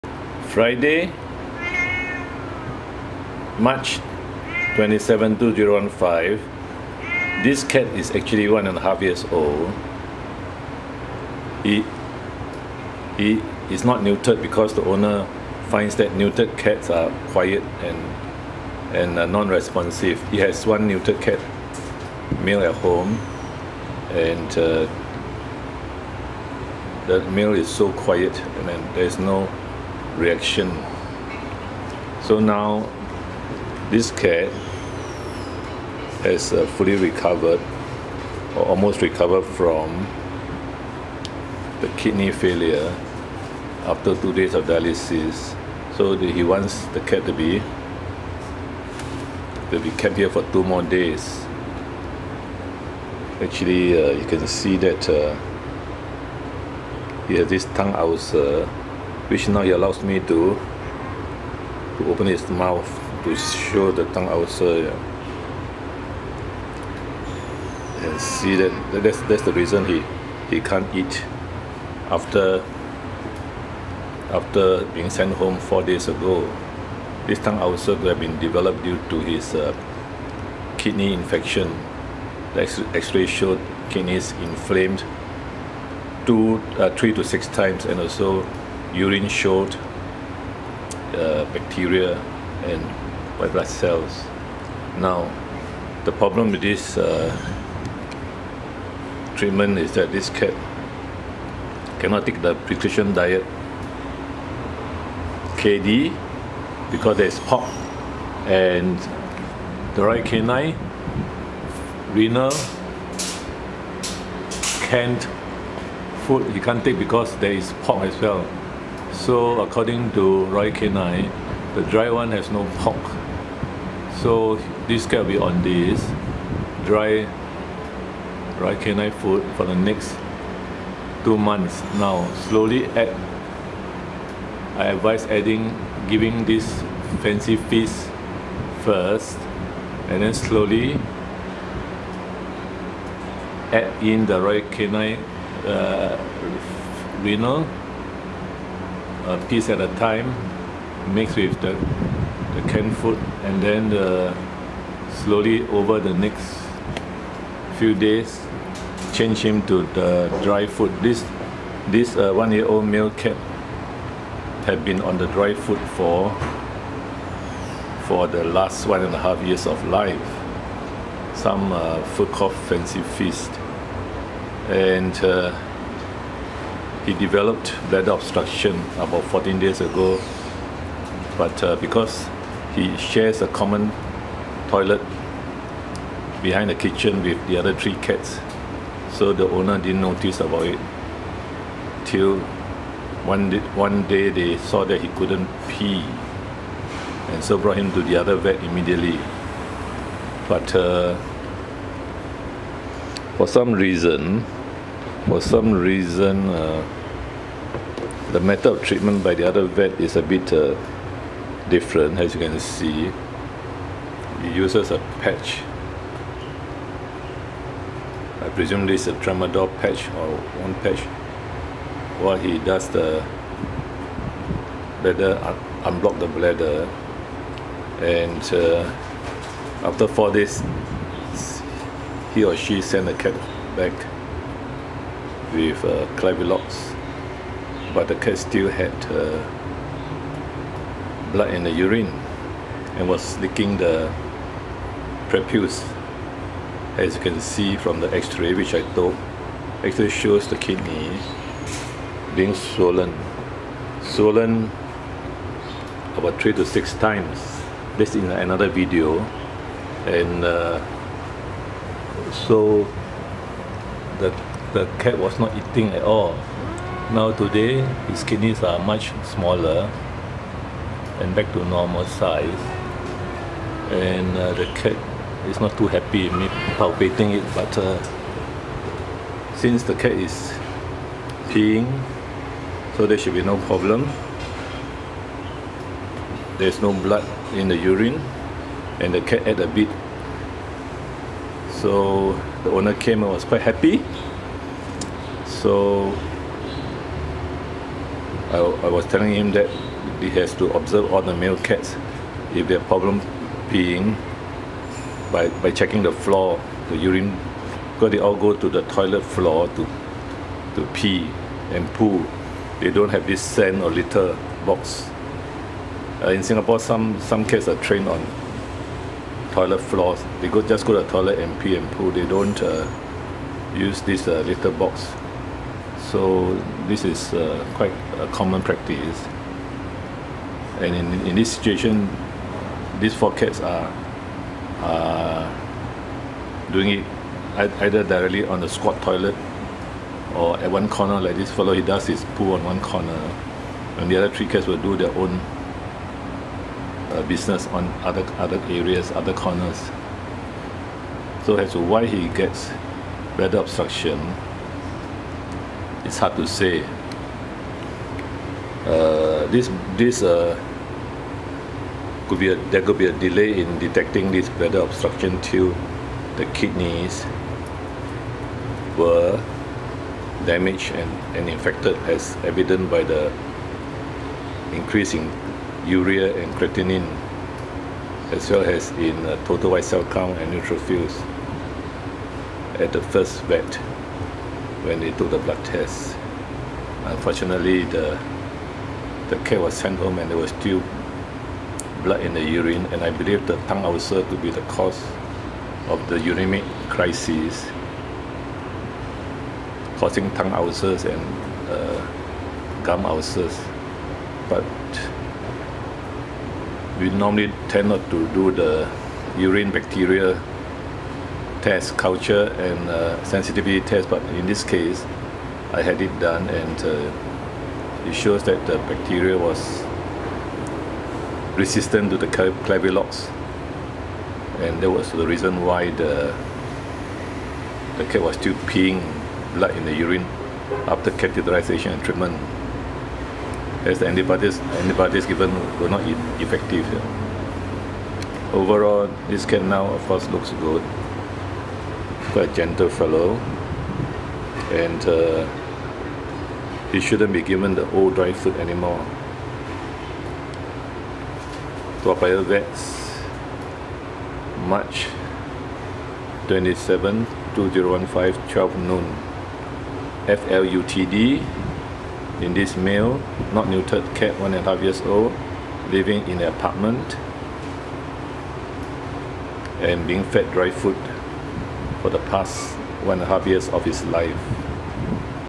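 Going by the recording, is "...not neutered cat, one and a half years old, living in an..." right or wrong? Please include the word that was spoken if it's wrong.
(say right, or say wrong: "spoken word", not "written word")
right.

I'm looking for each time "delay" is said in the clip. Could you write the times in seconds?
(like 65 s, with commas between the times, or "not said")
363 s.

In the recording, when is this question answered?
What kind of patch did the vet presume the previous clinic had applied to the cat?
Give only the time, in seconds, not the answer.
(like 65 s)
219 s.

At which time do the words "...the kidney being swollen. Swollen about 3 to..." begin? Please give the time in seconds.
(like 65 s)
250 s.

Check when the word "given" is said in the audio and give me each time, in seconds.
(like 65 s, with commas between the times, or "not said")
435 s, 447 s.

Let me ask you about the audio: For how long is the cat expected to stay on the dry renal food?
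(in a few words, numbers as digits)
2 months.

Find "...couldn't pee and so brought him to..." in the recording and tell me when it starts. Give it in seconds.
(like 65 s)
195 s.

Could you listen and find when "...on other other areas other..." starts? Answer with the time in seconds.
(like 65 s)
347 s.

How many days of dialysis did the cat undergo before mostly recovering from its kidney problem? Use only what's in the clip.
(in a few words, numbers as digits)
2.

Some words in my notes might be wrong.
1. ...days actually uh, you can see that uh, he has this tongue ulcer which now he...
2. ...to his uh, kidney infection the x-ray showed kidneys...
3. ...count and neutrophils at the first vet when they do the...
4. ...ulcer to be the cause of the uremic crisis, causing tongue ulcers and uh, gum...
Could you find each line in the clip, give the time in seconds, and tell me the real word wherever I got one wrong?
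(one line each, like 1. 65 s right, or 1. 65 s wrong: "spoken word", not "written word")
1. 50 s right
2. 79 s right
3. 380 s right
4. 393 s right.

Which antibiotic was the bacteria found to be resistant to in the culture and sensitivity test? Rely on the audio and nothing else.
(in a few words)
Clavulox.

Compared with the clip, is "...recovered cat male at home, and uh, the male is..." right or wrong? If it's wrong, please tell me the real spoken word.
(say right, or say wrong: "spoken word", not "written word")
wrong: "neutered", not "recovered".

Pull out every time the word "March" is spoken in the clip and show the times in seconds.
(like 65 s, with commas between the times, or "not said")
3 s, 454 s.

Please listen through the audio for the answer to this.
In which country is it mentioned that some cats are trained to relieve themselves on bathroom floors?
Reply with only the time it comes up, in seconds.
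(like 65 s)
316 s.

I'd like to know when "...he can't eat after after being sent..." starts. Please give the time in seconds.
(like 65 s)
70 s.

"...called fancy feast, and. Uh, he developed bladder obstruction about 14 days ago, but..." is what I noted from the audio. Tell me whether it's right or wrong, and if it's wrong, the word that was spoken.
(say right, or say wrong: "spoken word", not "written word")
right.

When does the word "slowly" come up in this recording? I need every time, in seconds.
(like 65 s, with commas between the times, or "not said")
132 s, 140 s, 155 s.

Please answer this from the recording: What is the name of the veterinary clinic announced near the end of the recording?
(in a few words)
Toa Payoh Vets.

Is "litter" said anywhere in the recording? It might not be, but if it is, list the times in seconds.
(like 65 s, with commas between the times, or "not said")
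313 s, 324 s.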